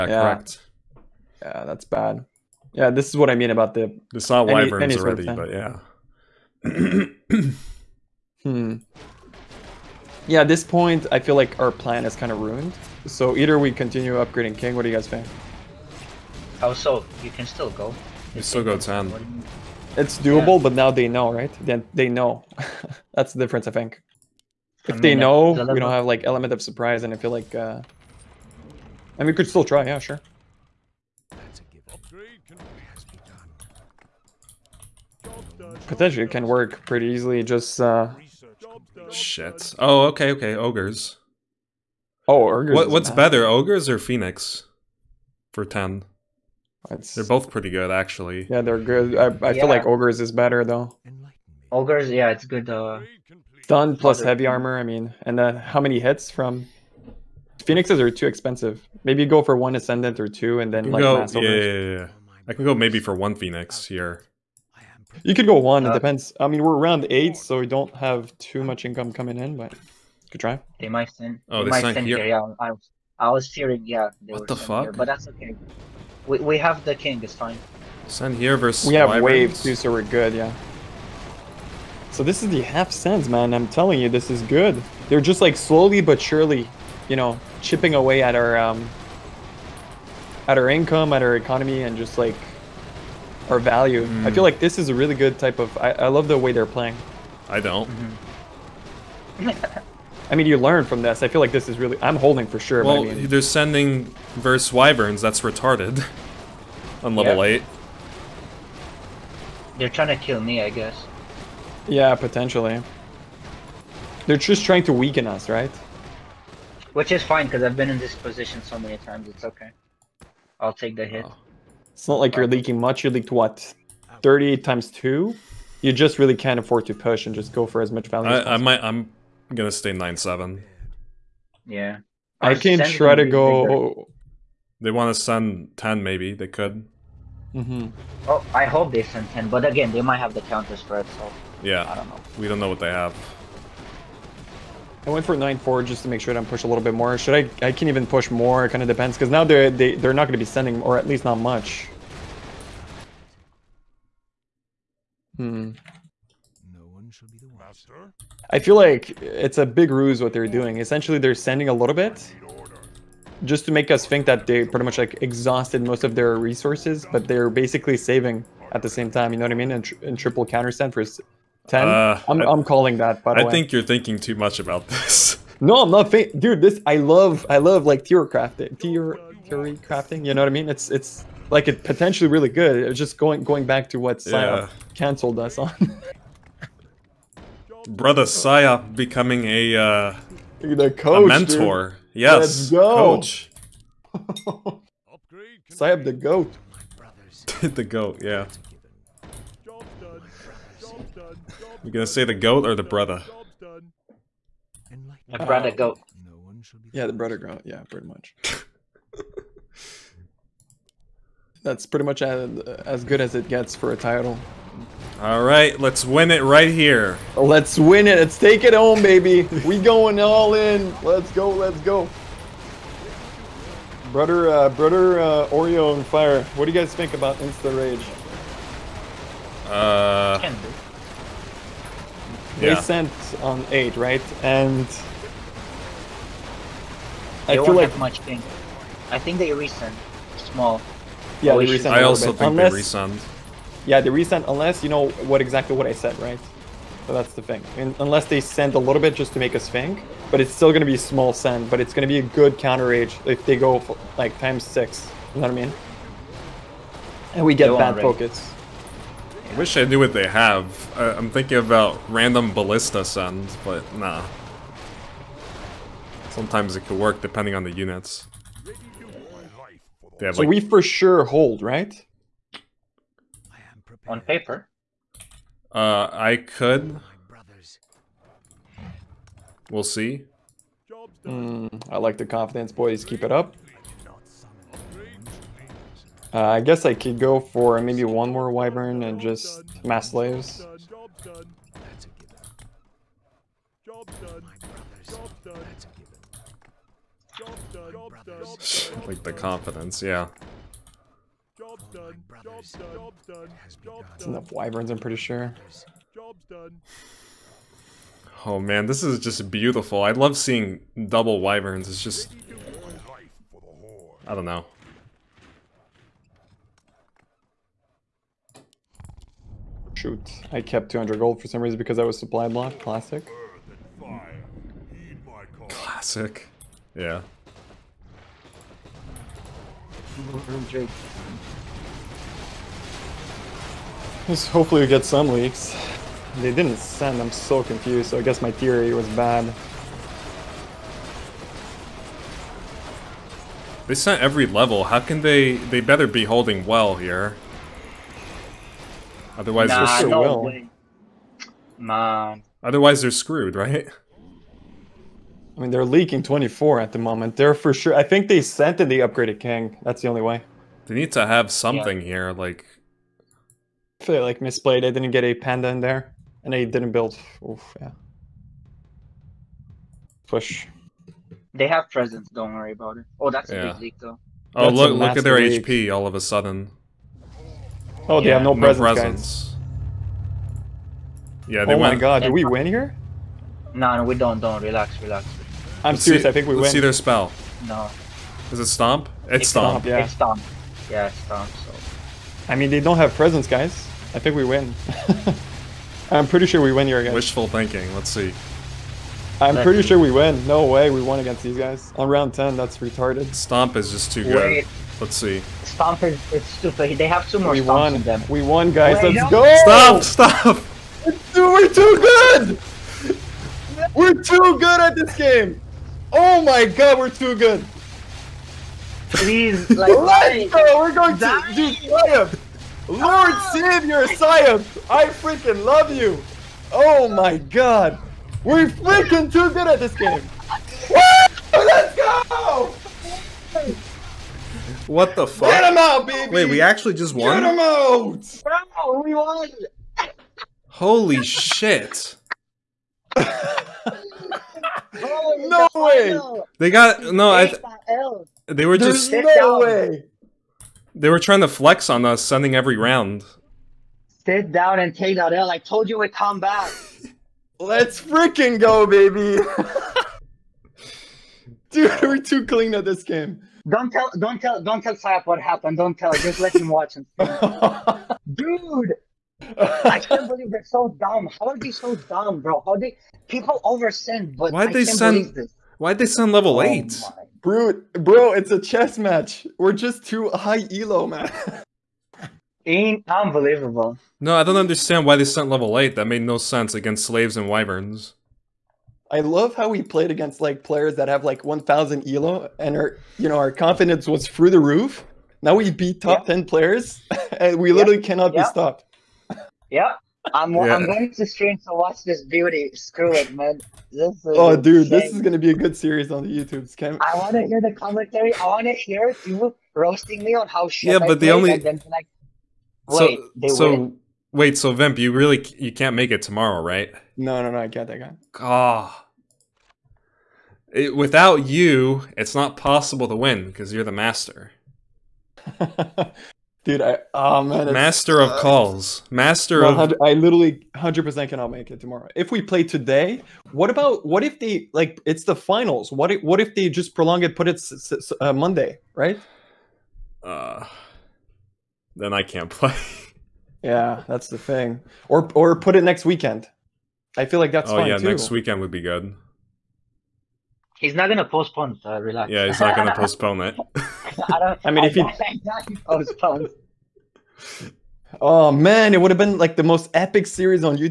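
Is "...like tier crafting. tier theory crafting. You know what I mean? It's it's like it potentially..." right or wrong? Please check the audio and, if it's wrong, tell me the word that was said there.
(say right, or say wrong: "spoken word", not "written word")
right.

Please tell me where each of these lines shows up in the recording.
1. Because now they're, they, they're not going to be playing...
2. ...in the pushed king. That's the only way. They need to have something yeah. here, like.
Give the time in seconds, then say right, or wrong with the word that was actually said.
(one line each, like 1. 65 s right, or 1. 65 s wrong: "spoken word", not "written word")
1. 149 s wrong: "sending", not "playing"
2. 358 s wrong: "upgraded", not "pushed".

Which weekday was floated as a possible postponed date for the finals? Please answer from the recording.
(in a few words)
Monday.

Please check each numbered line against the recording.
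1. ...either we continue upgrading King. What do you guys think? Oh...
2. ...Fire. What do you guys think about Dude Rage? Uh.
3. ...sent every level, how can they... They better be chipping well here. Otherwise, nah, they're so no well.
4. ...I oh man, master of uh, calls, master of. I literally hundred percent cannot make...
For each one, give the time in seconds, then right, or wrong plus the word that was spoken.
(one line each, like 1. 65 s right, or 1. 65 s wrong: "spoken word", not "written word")
1. 13 s right
2. 226 s wrong: "Insta", not "Dude"
3. 343 s wrong: "holding", not "chipping"
4. 526 s right.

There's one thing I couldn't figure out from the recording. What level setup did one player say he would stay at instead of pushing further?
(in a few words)
9-7.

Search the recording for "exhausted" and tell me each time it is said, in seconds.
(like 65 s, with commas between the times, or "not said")
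165 s.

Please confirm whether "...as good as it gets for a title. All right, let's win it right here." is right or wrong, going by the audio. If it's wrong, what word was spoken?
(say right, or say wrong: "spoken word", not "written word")
right.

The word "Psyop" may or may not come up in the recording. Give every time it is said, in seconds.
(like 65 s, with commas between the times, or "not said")
184 s, 188 s, 195 s.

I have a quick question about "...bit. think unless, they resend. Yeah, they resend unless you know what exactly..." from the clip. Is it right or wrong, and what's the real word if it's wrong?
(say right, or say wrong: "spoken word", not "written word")
right.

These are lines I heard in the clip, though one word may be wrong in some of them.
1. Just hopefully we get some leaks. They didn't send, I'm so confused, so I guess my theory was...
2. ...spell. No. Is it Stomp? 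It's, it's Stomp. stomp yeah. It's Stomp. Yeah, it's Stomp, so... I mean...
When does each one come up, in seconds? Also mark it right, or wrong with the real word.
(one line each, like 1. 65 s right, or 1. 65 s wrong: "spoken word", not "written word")
1. 334 s right
2. 386 s right.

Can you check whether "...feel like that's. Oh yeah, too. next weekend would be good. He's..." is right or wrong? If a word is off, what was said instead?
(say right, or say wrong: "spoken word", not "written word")
right.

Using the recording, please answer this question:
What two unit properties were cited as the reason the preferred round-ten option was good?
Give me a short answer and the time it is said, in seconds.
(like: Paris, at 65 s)
Stun plus heavy armor, at 53 s.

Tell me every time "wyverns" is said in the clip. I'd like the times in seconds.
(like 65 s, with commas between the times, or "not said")
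4 s, 104 s, 288 s, 304 s, 311 s, 487 s.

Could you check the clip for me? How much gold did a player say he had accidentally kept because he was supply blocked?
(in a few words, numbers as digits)
200.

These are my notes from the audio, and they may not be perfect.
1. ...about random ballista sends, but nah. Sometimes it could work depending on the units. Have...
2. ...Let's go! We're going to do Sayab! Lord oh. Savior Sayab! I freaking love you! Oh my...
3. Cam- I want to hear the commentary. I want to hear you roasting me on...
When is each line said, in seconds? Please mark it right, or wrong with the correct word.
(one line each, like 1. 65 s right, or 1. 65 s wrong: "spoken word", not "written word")
1. 261 s right
2. 419 s right
3. 506 s right.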